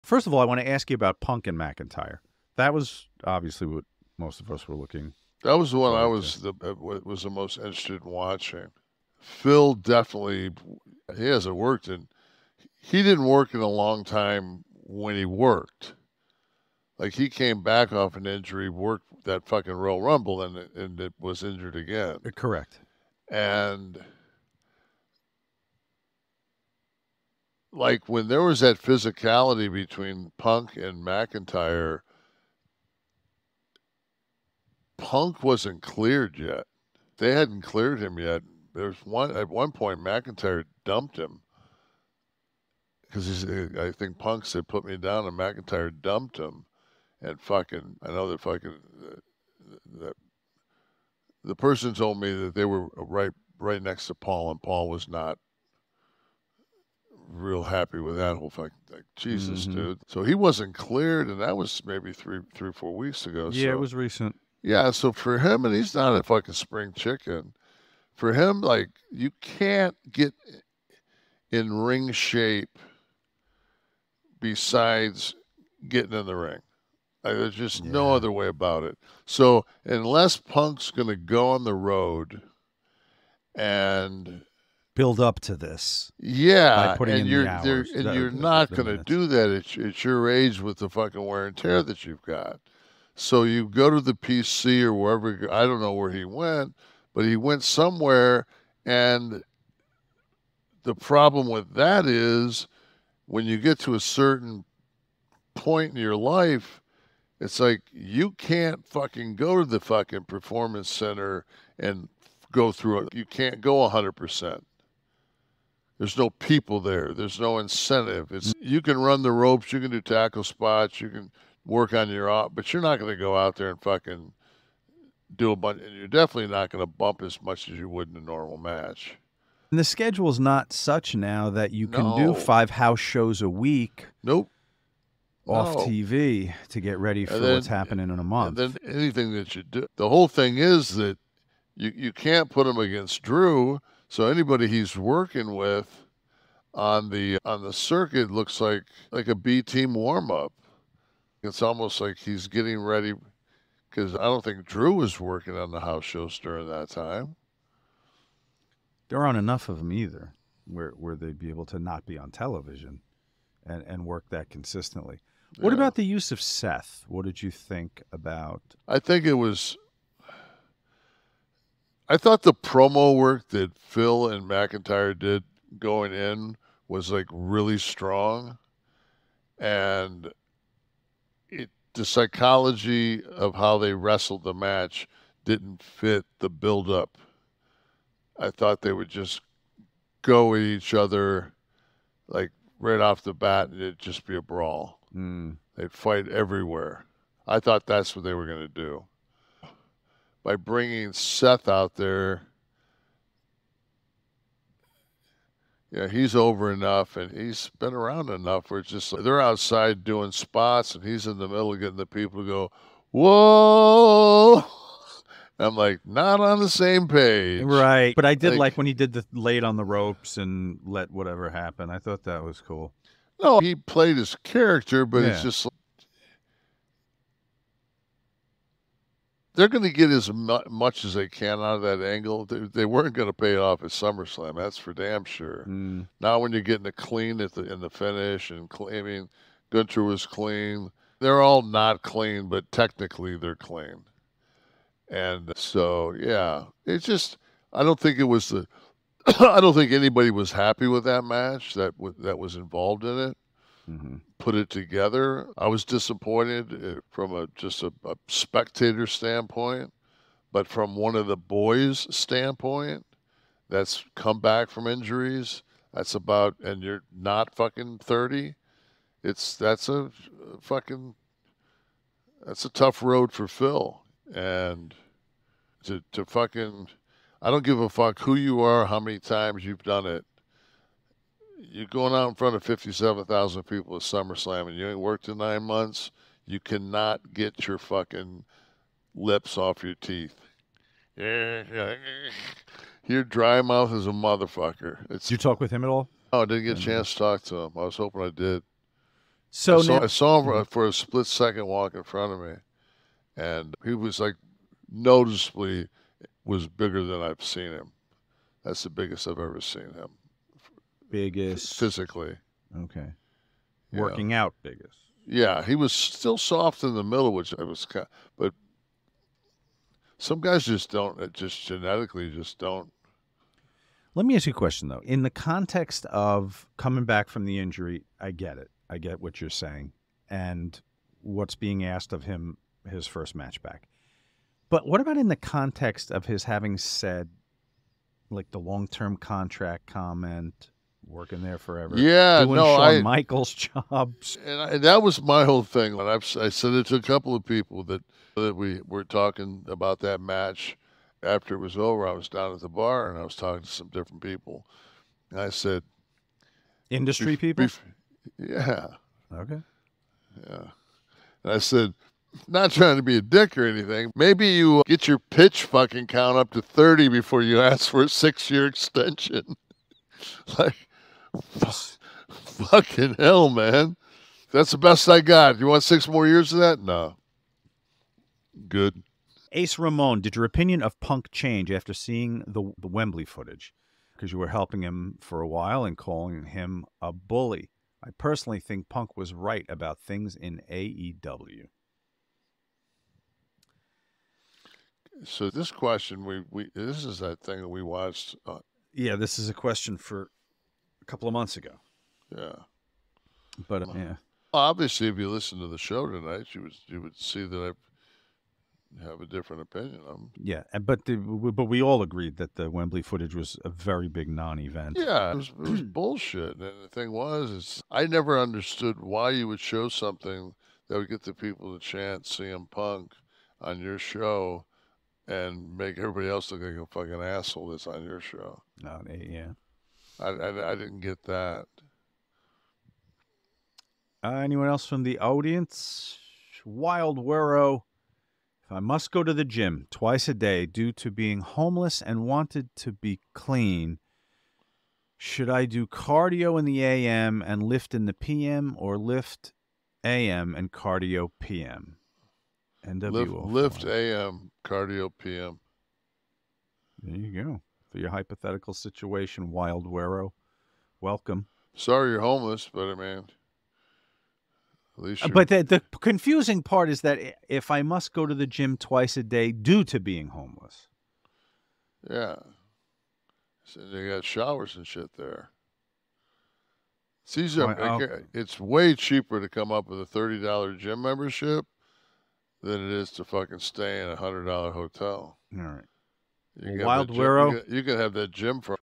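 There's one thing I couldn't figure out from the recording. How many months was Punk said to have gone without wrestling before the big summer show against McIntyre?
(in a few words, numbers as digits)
9.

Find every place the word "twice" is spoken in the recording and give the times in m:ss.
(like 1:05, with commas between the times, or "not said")
7:19, 7:48.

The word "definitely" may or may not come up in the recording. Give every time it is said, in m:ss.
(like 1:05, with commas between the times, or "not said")
0:09, 2:06.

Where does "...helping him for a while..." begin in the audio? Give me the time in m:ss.
6:24.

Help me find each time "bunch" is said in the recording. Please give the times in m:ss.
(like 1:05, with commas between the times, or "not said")
2:05.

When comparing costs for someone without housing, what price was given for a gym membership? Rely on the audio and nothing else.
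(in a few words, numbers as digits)
$30.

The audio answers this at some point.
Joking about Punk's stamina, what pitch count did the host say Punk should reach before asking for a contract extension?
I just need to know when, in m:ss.
6:06.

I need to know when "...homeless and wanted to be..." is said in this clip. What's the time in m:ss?
7:21.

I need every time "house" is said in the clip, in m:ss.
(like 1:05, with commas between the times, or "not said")
2:12, 2:35.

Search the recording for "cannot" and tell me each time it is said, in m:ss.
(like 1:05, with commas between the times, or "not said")
4:46.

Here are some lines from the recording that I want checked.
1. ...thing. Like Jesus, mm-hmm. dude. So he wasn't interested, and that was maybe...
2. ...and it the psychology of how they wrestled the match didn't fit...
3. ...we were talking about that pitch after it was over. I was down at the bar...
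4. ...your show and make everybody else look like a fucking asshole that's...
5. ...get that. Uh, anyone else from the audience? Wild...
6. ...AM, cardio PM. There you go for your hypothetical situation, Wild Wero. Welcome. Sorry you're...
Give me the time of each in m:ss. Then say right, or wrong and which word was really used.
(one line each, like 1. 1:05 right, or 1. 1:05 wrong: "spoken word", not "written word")
1. 0:58 wrong: "cleared", not "interested"
2. 2:59 right
3. 5:48 wrong: "match", not "pitch"
4. 7:03 right
5. 7:10 right
6. 7:33 right.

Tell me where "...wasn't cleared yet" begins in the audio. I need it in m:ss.
0:35.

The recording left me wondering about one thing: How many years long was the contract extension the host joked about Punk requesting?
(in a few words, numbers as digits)
6.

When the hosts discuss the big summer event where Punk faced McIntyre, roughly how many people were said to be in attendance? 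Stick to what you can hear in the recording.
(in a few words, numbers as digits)
57,000.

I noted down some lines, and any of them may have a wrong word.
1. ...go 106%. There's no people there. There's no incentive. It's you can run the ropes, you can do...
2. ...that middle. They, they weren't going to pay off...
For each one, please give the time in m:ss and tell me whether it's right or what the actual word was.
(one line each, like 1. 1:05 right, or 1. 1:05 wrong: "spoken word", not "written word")
1. 1:53 wrong: "100", not "106"
2. 3:51 wrong: "angle", not "middle".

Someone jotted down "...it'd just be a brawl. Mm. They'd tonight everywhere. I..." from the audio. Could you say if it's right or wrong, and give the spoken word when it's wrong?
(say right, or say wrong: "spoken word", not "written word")
wrong: "fight", not "tonight".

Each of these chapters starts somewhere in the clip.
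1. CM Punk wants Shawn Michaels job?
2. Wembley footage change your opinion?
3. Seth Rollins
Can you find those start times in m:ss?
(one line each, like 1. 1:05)
1. 5:23
2. 6:19
3. 2:45.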